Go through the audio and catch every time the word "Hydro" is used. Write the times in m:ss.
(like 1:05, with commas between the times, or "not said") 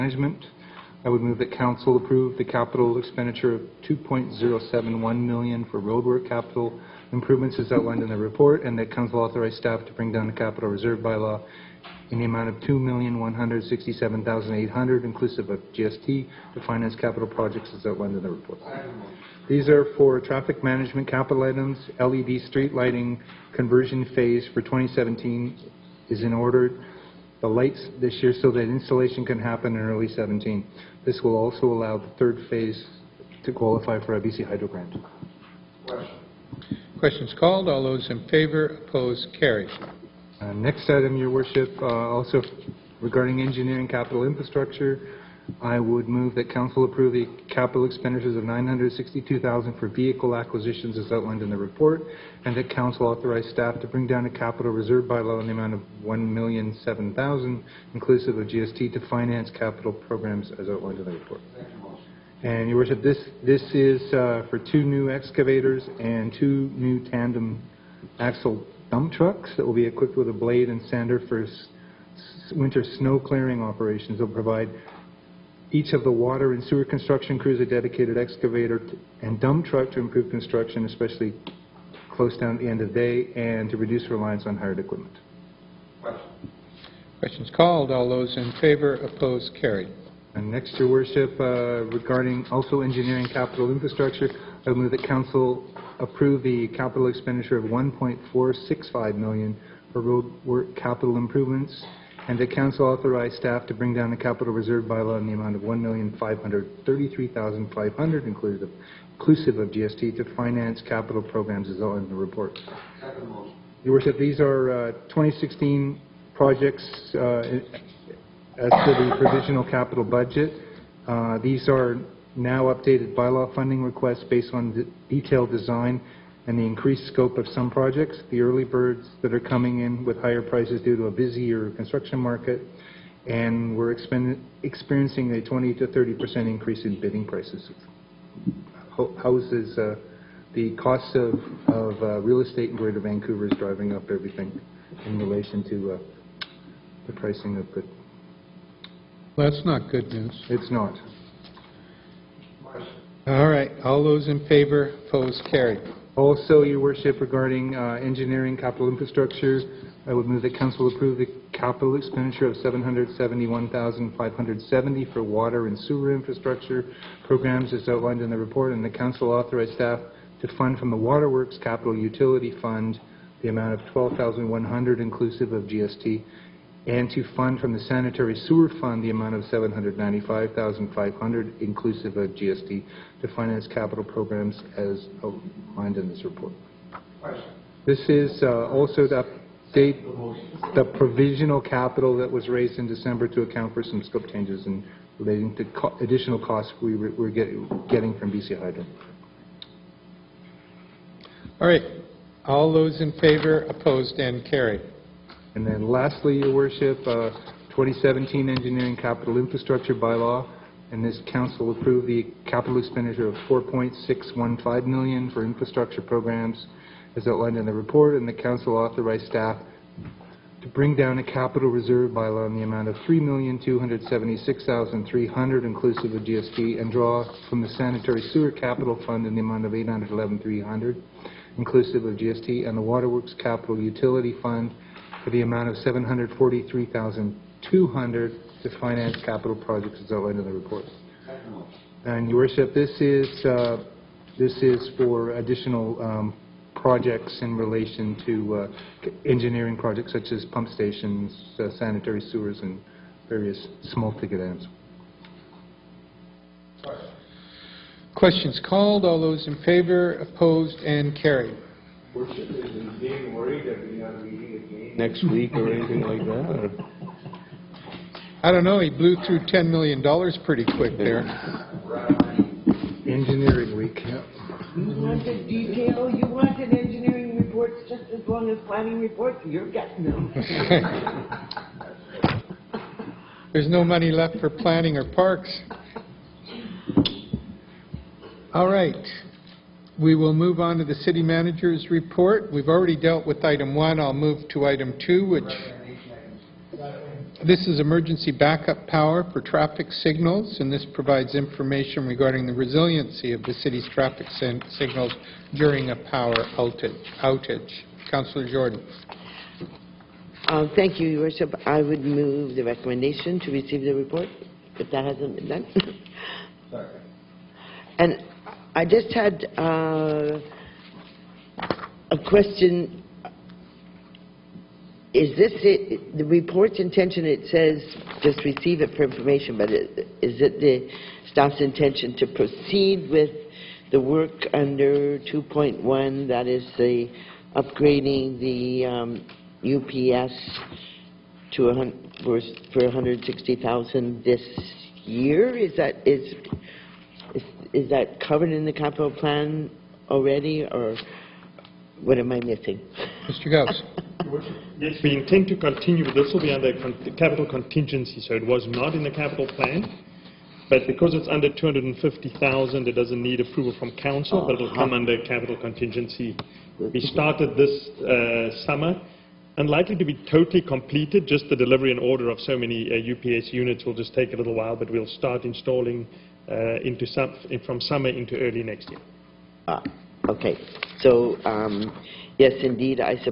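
0:34, 3:18.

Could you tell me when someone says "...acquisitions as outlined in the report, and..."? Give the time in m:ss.
0:50.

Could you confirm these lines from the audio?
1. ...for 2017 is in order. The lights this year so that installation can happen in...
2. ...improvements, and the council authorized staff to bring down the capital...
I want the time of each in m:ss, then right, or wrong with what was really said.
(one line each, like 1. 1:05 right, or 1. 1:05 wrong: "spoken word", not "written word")
1. 0:24 right
2. 1:41 right.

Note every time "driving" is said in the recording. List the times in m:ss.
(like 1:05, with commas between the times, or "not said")
2:23.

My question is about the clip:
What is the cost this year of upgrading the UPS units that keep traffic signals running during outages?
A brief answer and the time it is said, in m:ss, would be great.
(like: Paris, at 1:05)
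160,000, at 5:42.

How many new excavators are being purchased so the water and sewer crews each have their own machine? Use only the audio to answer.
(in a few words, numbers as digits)
2.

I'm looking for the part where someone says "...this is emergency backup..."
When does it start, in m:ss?
4:57.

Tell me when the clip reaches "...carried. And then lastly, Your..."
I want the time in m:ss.
3:24.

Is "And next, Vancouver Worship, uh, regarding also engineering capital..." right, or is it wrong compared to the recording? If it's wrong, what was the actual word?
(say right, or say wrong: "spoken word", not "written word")
wrong: "Your", not "Vancouver".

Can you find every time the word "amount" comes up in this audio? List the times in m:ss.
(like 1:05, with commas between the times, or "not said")
0:12, 0:55, 1:45, 2:53, 2:59, 3:42, 3:49, 3:55.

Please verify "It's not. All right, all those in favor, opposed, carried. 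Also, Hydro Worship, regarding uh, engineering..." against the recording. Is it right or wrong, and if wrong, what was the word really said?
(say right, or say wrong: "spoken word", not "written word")
wrong: "Your", not "Hydro".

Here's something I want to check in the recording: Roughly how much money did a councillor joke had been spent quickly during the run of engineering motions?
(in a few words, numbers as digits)
$10 million.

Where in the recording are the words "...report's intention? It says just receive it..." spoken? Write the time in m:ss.
5:26.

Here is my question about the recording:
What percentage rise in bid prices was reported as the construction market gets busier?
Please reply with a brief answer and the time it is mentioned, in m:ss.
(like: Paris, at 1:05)
20 to 30 percent, at 2:15.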